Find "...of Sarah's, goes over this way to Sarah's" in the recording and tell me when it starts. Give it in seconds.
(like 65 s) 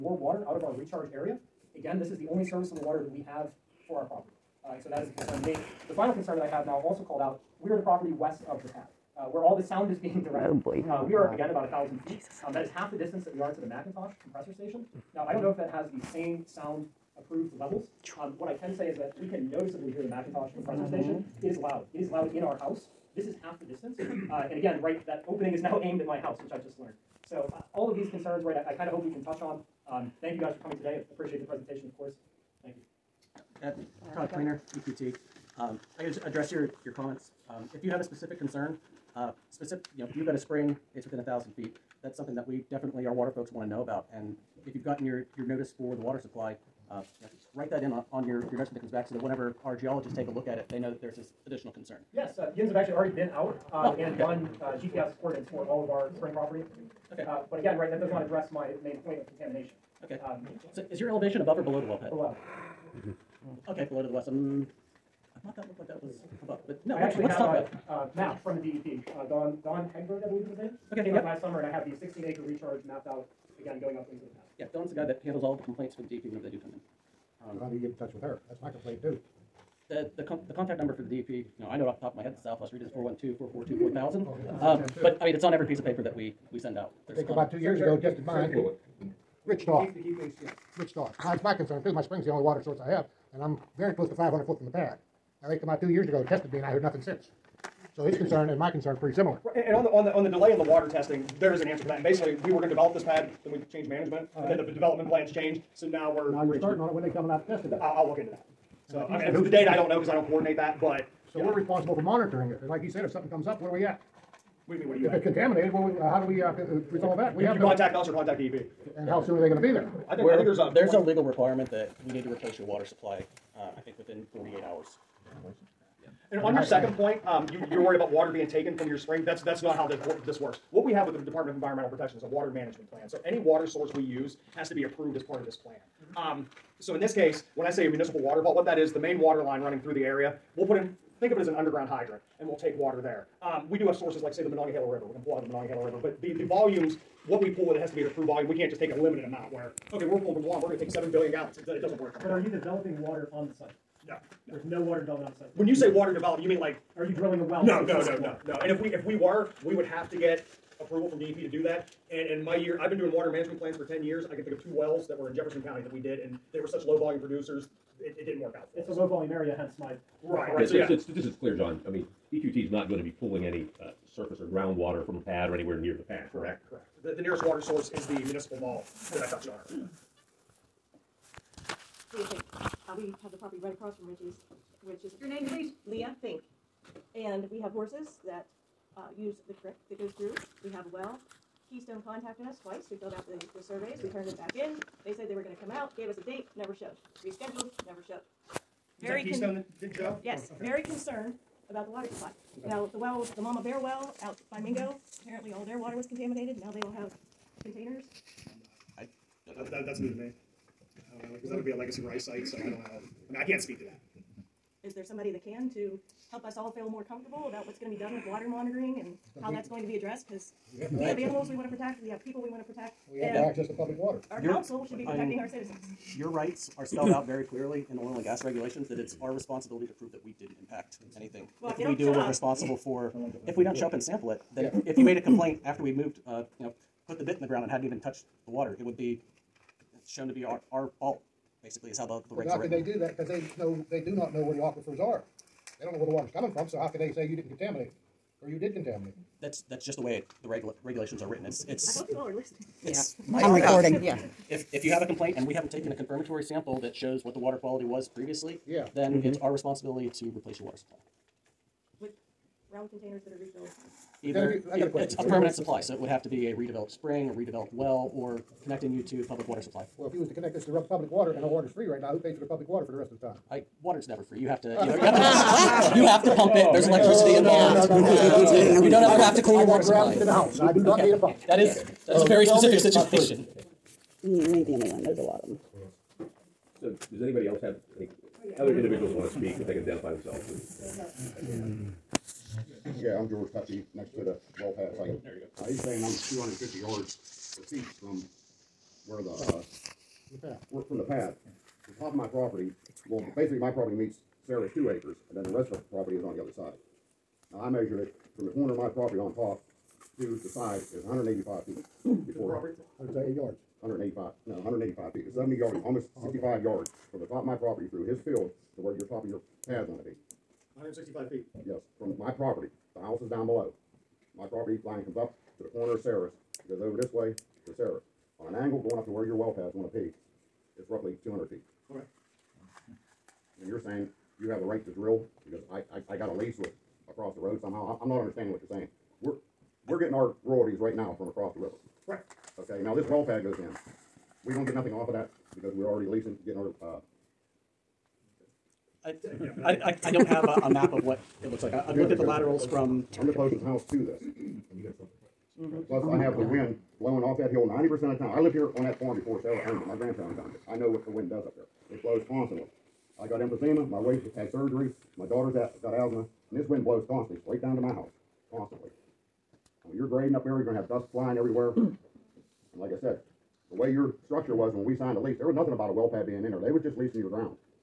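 325 s.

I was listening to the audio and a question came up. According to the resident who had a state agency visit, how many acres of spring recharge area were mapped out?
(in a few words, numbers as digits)
16 acres.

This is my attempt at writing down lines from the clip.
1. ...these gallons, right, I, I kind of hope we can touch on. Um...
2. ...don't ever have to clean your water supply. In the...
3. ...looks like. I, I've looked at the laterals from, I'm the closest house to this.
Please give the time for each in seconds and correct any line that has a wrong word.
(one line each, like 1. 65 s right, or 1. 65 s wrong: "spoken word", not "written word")
1. 27 s wrong: "concerns", not "gallons"
2. 278 s right
3. 351 s right.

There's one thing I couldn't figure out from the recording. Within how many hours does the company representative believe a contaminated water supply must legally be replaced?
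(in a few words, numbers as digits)
48 hours.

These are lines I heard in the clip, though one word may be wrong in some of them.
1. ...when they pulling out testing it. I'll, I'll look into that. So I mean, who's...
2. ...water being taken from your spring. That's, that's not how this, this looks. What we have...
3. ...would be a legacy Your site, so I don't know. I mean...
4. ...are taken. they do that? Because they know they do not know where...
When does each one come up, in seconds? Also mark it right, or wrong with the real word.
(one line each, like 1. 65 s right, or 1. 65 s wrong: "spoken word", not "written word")
1. 106 s wrong: "coming", not "pulling"
2. 128 s wrong: "works", not "looks"
3. 211 s wrong: "Rice", not "Your"
4. 242 s wrong: "written", not "taken".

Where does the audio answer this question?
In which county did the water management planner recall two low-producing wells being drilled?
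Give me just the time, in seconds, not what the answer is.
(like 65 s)
165 s.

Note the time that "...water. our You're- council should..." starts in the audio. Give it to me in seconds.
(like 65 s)
223 s.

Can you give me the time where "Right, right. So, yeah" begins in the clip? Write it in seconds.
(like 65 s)
170 s.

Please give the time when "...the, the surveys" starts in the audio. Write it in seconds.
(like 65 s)
193 s.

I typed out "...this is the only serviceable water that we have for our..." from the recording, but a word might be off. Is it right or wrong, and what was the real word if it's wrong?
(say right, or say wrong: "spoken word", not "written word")
right.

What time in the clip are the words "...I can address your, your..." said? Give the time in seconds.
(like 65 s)
35 s.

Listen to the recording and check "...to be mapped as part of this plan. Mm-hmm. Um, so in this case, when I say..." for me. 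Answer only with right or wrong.
wrong.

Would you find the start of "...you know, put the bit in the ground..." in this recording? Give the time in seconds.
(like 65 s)
236 s.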